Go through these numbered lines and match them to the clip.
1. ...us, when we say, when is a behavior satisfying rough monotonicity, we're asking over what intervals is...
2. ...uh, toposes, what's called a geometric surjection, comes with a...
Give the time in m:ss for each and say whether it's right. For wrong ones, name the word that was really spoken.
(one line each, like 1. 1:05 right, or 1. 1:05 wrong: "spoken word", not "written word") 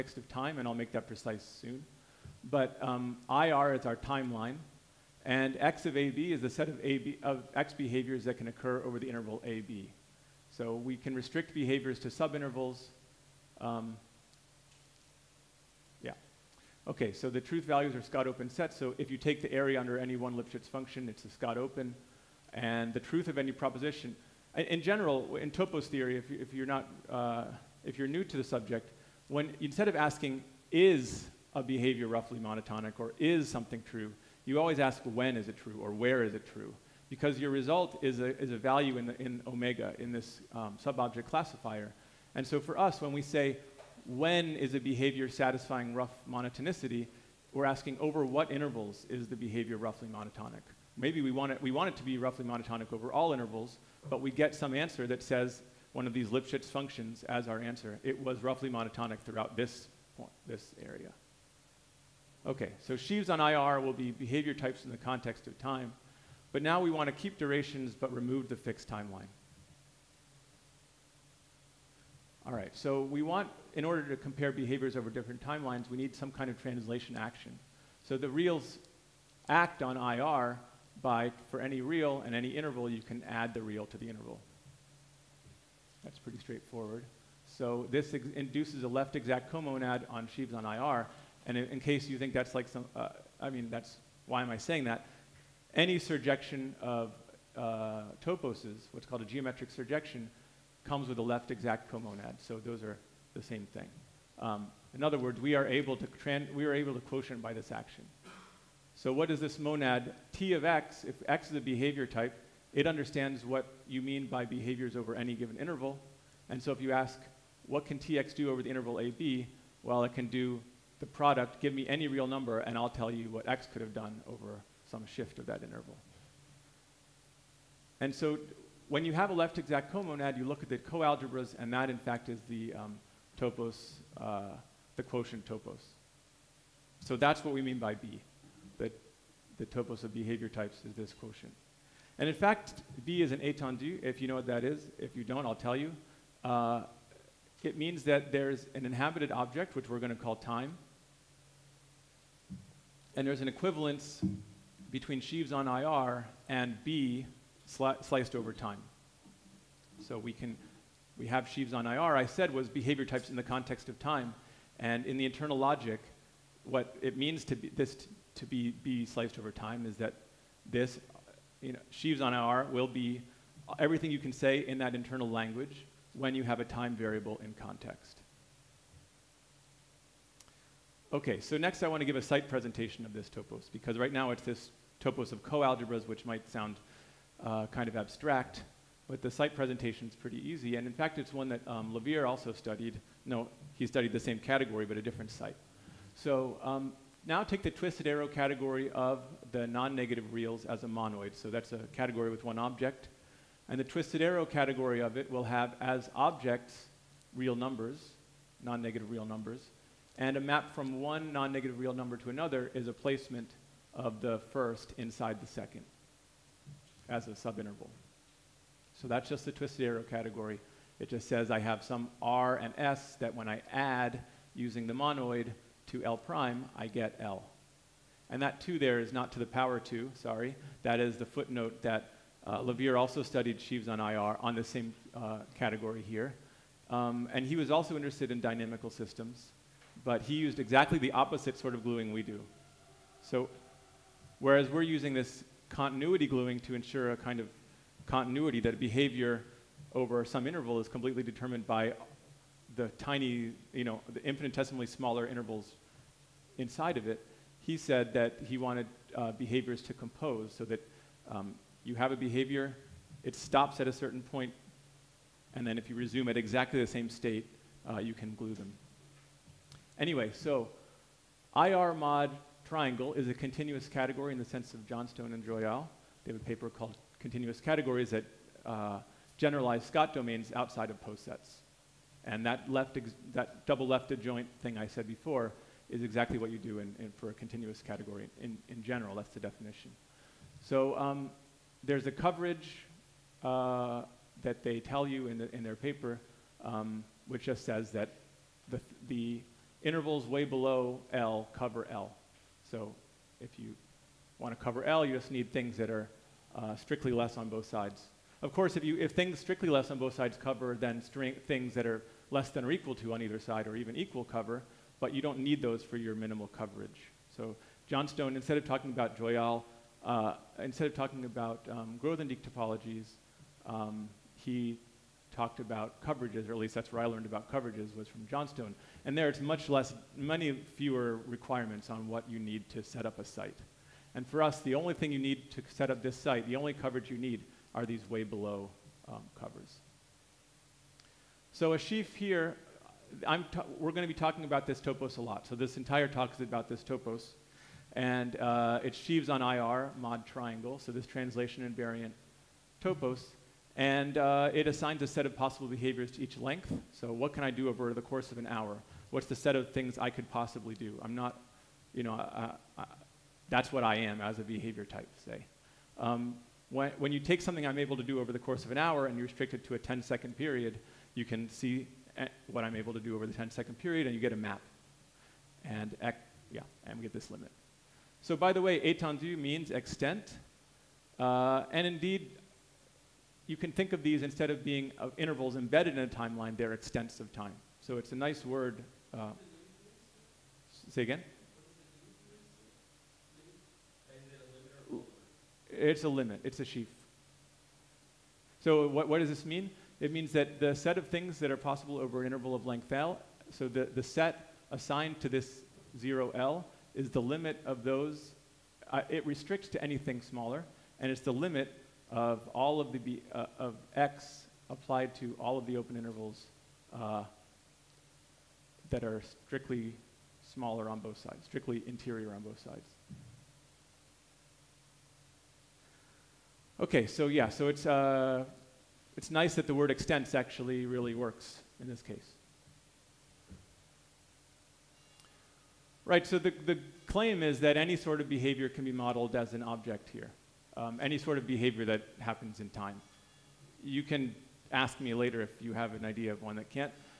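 1. 0:42 right
2. 1:37 right.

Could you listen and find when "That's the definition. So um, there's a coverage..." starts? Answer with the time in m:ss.
4:49.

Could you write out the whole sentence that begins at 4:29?
Anyway, so IR mod triangle is a continuous category in the sense of Johnstone and Joyal.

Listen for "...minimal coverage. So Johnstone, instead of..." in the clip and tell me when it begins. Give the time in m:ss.
5:16.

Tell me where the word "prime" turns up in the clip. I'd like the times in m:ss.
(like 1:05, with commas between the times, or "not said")
3:46.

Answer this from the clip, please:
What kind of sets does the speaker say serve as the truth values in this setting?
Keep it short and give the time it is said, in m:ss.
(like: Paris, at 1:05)
Scott open sets, at 0:17.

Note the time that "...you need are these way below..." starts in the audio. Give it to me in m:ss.
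5:37.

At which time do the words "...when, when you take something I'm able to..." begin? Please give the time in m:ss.
6:06.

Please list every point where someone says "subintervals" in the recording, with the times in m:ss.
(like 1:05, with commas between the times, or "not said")
0:12, 3:37.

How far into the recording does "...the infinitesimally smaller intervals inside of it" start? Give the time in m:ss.
4:14.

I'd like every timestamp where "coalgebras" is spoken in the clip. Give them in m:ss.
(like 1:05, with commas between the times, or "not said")
2:10, 3:05.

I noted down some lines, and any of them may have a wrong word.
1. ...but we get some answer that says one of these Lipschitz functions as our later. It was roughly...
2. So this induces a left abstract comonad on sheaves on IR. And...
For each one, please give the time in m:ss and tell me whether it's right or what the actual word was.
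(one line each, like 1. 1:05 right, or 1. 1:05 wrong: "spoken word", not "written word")
1. 0:54 wrong: "answer", not "later"
2. 1:27 wrong: "exact", not "abstract".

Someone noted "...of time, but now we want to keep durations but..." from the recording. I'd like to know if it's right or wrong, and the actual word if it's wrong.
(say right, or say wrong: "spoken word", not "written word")
right.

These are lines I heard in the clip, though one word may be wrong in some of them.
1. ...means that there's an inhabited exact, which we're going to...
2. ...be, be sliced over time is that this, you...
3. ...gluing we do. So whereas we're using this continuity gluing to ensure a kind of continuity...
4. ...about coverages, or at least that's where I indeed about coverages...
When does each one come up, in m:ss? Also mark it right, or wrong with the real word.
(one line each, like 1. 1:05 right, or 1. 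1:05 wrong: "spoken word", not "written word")
1. 2:27 wrong: "object", not "exact"
2. 2:48 right
3. 4:01 right
4. 5:25 wrong: "learned", not "indeed".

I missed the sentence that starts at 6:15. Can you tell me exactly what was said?
And, yeah, and we get this limit.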